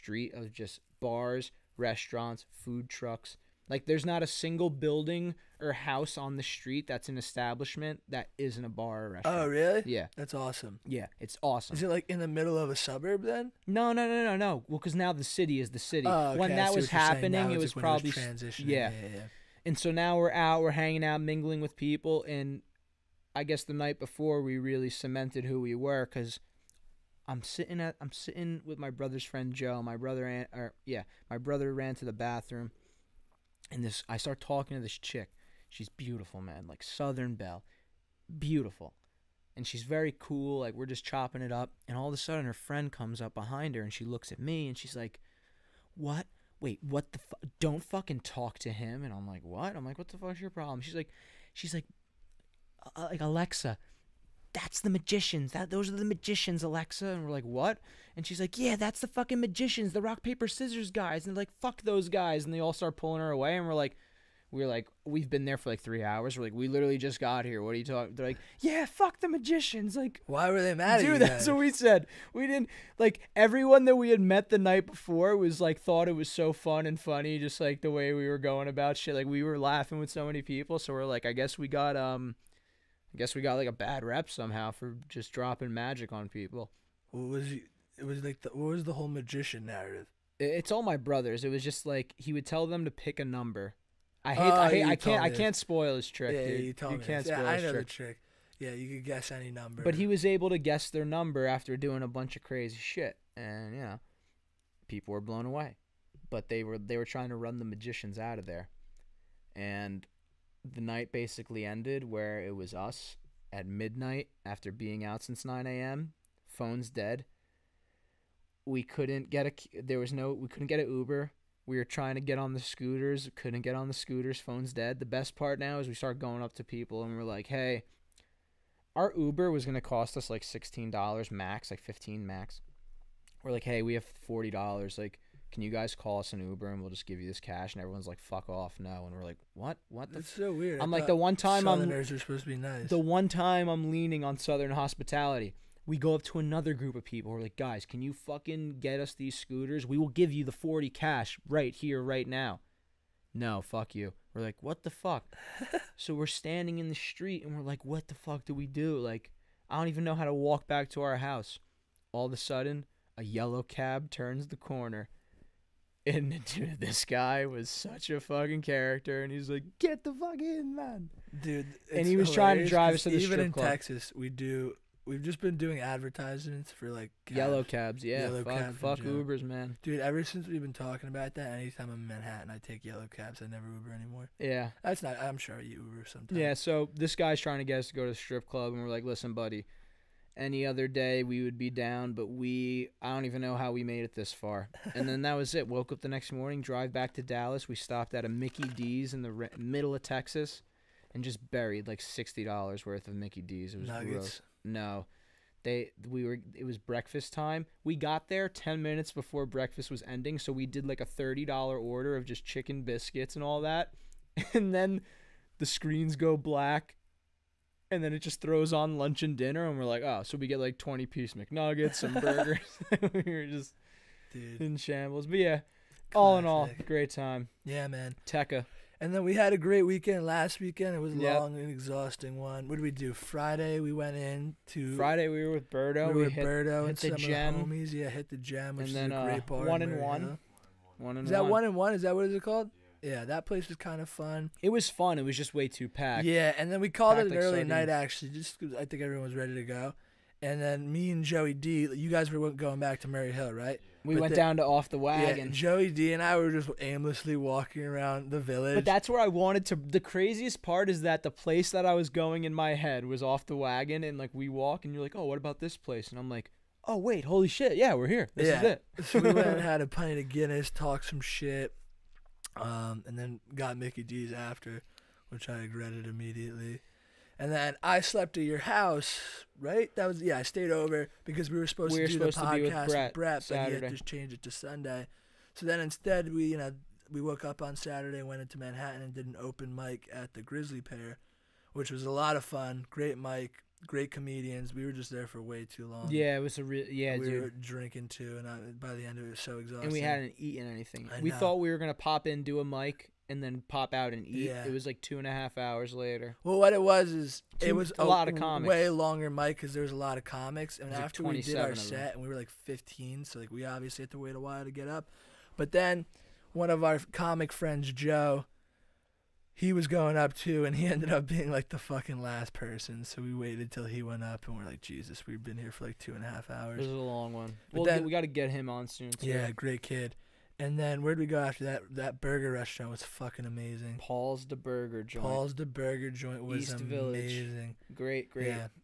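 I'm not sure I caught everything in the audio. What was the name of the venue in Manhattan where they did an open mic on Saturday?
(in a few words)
Grisly Pear.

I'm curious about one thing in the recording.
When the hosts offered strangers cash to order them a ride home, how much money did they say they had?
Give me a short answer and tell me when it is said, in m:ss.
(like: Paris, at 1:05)
$40, at 2:14.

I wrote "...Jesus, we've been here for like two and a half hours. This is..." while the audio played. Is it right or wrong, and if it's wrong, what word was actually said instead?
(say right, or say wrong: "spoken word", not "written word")
right.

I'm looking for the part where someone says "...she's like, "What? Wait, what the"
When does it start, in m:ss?
0:44.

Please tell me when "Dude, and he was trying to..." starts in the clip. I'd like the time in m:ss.
2:51.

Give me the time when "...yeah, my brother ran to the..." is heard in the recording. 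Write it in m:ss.
0:30.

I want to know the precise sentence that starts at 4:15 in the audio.
Yeah, Joey D and I were just aimlessly walking around the village.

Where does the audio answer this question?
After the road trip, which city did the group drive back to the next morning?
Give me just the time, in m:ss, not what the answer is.
3:17.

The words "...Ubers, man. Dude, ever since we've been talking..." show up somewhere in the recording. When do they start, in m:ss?
2:58.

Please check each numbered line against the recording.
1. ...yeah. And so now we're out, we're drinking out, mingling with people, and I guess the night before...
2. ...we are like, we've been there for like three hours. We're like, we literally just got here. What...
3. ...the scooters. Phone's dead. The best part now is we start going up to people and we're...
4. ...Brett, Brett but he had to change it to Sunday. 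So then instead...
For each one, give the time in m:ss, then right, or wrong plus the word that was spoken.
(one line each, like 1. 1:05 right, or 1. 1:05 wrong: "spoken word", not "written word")
1. 0:19 wrong: "hanging", not "drinking"
2. 1:04 right
3. 2:03 right
4. 4:42 right.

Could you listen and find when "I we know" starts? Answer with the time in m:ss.
5:01.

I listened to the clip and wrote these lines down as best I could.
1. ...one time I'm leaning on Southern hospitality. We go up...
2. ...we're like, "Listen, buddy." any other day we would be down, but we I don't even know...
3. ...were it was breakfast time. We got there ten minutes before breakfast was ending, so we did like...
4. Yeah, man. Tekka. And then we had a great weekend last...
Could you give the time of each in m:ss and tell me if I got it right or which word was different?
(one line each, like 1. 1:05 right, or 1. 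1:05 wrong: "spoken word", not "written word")
1. 2:22 right
2. 3:08 right
3. 3:26 right
4. 3:47 right.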